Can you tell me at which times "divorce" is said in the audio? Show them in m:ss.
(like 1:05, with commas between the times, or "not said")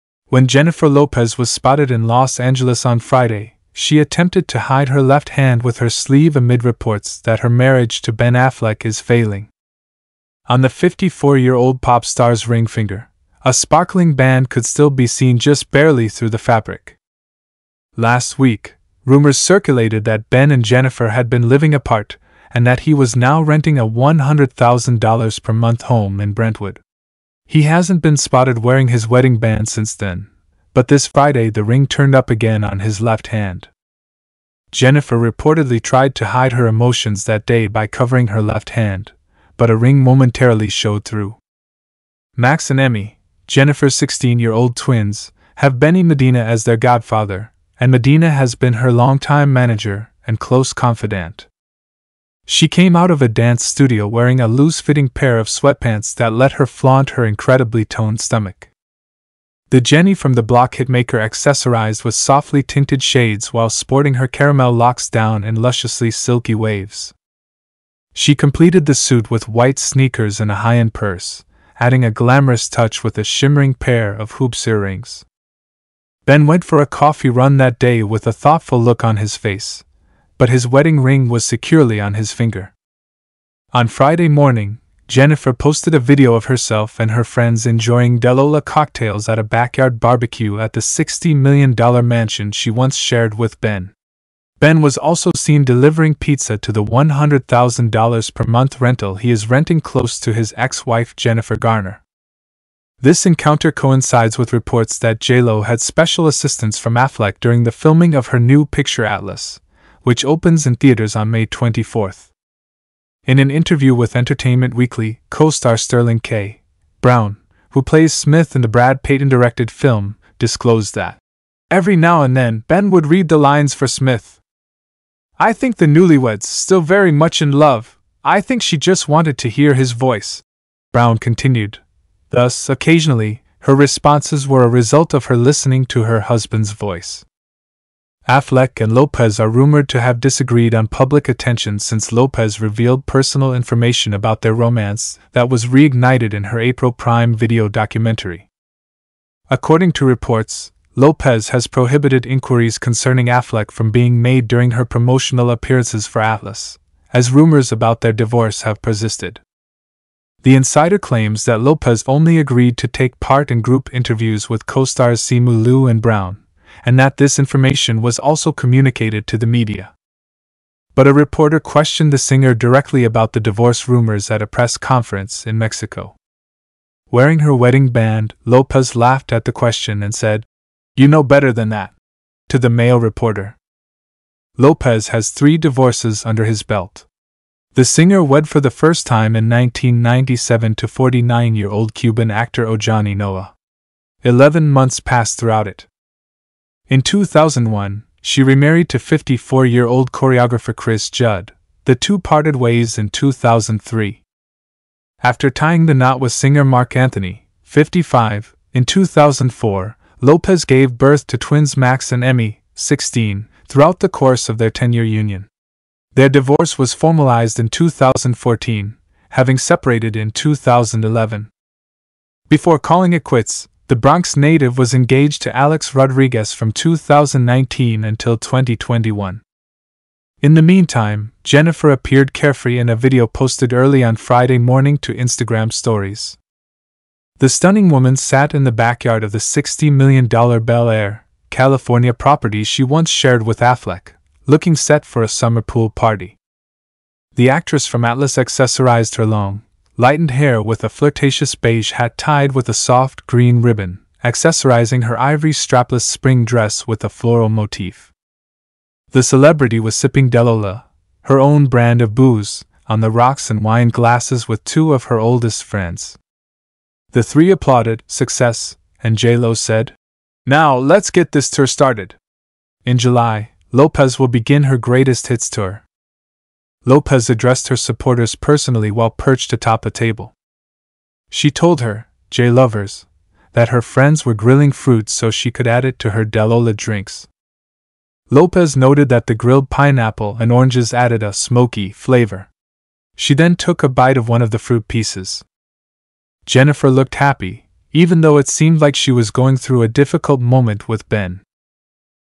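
2:38, 2:53, 3:05, 3:36.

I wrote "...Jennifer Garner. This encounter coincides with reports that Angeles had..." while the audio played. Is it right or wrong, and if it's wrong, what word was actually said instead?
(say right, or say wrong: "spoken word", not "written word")
wrong: "JLo", not "Angeles".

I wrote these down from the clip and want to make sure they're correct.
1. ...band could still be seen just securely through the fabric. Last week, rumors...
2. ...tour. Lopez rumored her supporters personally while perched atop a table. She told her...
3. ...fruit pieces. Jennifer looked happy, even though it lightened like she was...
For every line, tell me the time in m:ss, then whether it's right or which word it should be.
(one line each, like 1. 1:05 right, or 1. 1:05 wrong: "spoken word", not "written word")
1. 0:14 wrong: "barely", not "securely"
2. 4:35 wrong: "addressed", not "rumored"
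3. 4:54 wrong: "seemed", not "lightened".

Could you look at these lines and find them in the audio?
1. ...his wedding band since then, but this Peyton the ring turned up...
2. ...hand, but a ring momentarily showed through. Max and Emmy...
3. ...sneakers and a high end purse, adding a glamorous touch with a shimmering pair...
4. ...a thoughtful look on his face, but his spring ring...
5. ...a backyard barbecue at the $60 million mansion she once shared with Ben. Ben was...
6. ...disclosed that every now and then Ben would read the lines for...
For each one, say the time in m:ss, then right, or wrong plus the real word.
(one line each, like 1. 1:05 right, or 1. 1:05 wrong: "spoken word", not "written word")
1. 0:28 wrong: "Friday", not "Peyton"
2. 0:38 right
3. 1:09 right
4. 1:18 wrong: "wedding", not "spring"
5. 1:29 right
6. 2:00 right.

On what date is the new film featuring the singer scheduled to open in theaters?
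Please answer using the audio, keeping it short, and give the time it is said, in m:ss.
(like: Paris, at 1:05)
May 24th, at 1:51.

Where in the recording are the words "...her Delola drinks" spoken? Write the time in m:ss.
4:46.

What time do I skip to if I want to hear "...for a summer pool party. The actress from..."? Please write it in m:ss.
4:05.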